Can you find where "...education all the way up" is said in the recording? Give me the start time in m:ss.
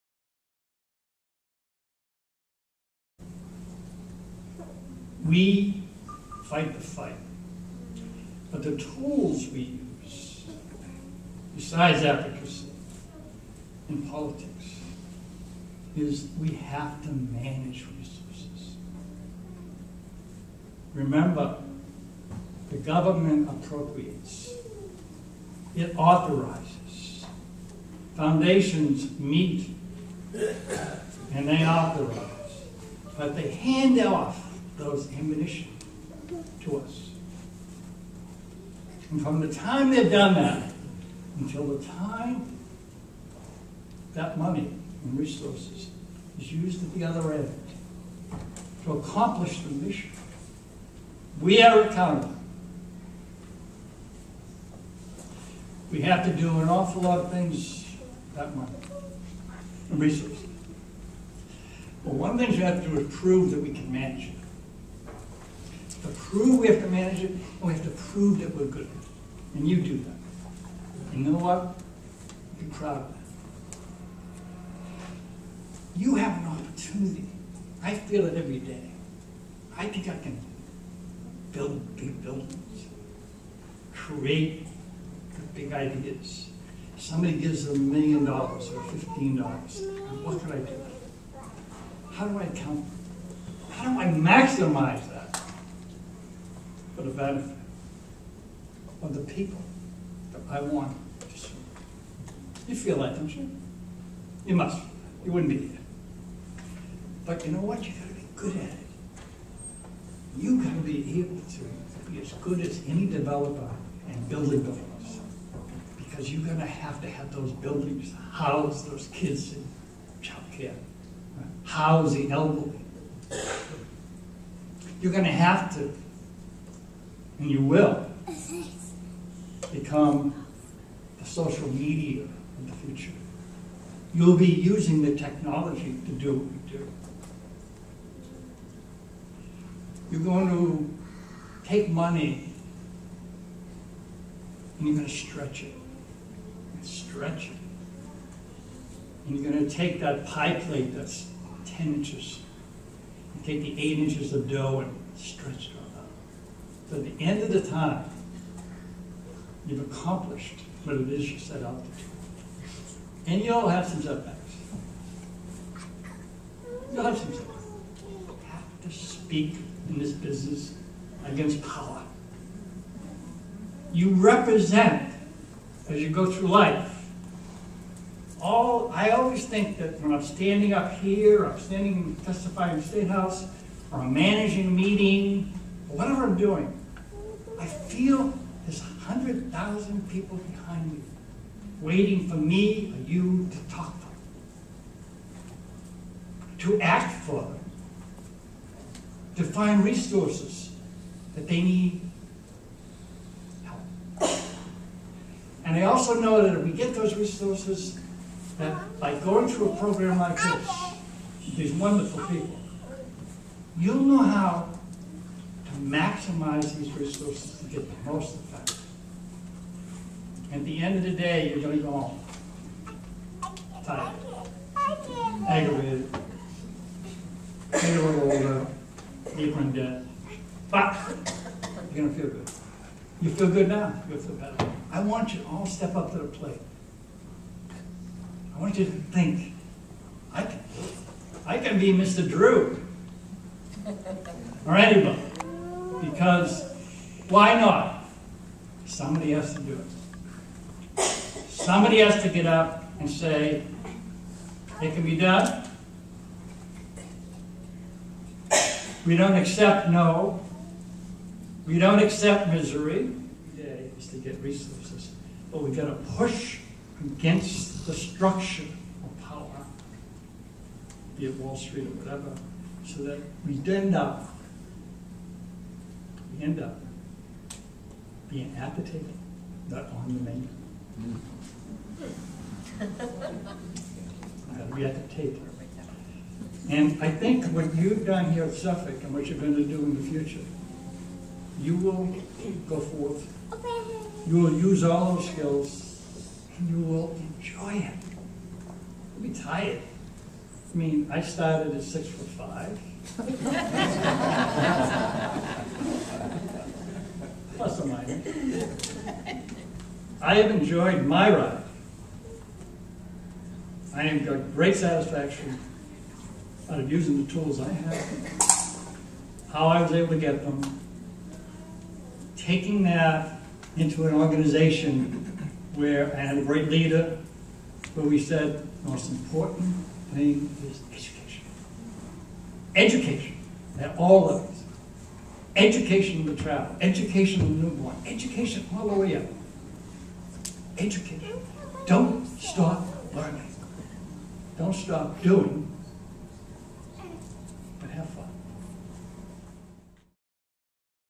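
5:38.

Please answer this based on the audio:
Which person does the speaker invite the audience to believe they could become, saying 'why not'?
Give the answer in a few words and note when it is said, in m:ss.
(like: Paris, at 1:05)
Mr. Drew, at 4:01.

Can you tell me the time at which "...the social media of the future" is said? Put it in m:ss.
2:11.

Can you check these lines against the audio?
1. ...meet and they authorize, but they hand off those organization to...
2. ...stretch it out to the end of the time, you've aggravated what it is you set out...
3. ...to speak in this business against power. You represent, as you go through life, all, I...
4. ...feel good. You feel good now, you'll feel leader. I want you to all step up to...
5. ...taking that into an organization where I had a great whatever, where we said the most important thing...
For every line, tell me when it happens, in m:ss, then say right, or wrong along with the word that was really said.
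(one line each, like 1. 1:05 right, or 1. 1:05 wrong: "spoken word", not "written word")
1. 0:29 wrong: "ammunition", not "organization"
2. 2:35 wrong: "accomplished", not "aggravated"
3. 2:48 right
4. 3:52 wrong: "better", not "leader"
5. 5:22 wrong: "leader", not "whatever".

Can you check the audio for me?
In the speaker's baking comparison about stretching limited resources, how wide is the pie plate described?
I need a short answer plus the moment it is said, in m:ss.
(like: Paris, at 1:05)
10 inches, at 2:31.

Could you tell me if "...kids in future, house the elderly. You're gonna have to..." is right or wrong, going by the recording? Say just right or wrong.
wrong.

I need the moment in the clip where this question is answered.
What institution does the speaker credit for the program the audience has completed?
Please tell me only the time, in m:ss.
4:48.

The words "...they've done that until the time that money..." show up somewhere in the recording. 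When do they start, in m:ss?
0:39.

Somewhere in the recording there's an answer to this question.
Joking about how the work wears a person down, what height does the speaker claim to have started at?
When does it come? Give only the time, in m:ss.
5:01.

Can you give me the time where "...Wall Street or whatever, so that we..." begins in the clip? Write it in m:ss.
4:31.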